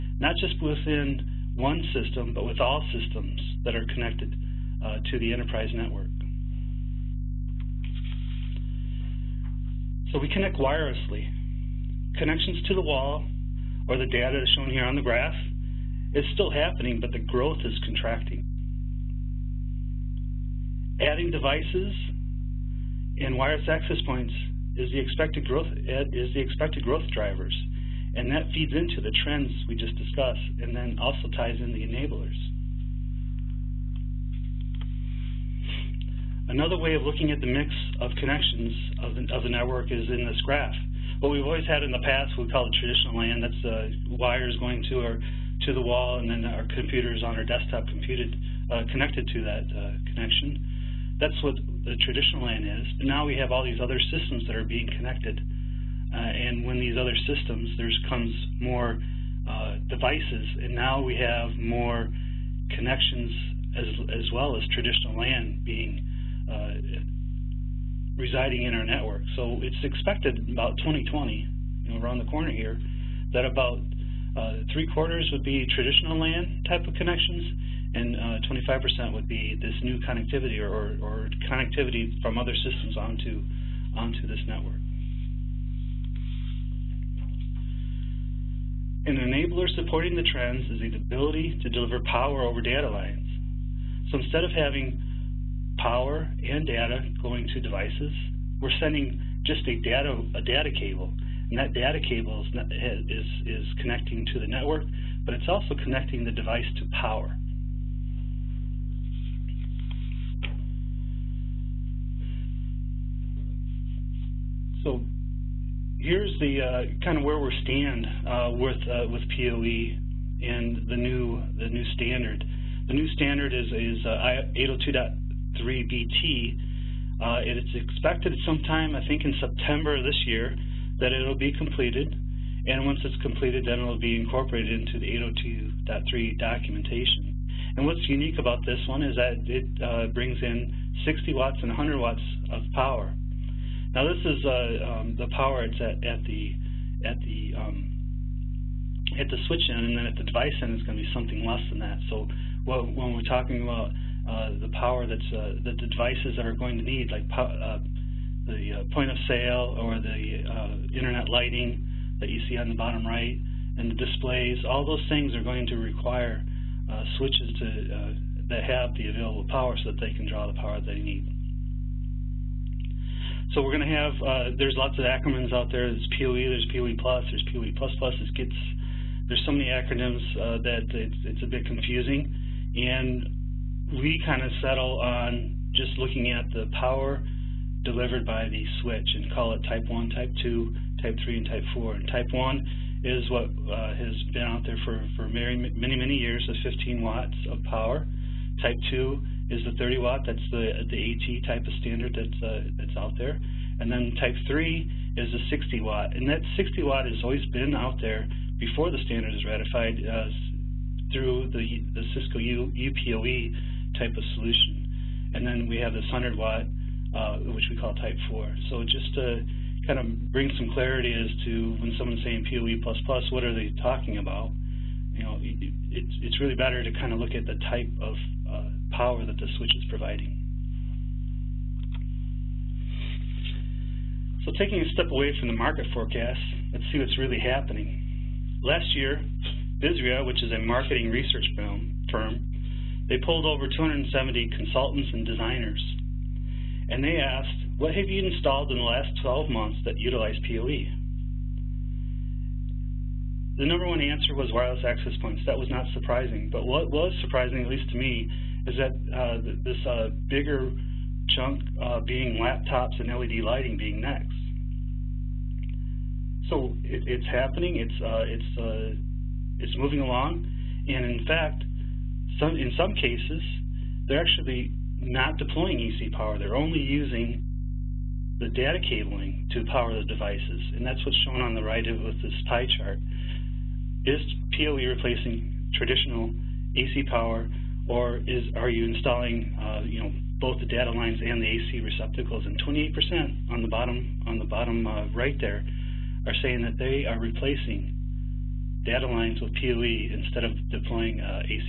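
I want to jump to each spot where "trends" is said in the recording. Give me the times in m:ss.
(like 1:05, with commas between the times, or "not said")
0:29, 1:30.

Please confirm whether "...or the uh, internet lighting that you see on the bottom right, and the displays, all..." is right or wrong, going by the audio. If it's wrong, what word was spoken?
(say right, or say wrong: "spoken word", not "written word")
right.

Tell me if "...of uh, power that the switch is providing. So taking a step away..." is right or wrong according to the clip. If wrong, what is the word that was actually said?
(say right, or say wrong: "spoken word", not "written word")
right.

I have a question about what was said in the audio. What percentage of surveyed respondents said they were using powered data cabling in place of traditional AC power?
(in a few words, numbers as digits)
28%.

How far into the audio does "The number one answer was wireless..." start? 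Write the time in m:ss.
4:13.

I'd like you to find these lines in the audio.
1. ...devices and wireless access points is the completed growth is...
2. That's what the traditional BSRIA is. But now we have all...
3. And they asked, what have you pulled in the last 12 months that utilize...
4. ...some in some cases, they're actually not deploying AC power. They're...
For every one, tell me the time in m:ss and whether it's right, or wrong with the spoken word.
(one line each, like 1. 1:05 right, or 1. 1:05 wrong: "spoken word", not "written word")
1. 0:21 wrong: "expected", not "completed"
2. 0:51 wrong: "LAN", not "BSRIA"
3. 4:06 wrong: "installed", not "pulled"
4. 4:32 right.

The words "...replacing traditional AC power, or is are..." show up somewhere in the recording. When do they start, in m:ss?
4:44.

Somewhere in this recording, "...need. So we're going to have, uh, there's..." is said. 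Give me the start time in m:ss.
2:50.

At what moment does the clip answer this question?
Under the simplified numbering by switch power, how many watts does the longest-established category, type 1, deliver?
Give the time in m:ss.
3:16.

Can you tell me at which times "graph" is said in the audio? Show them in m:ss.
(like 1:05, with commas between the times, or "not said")
0:15, 0:40.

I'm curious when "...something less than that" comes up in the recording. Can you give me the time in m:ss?
2:31.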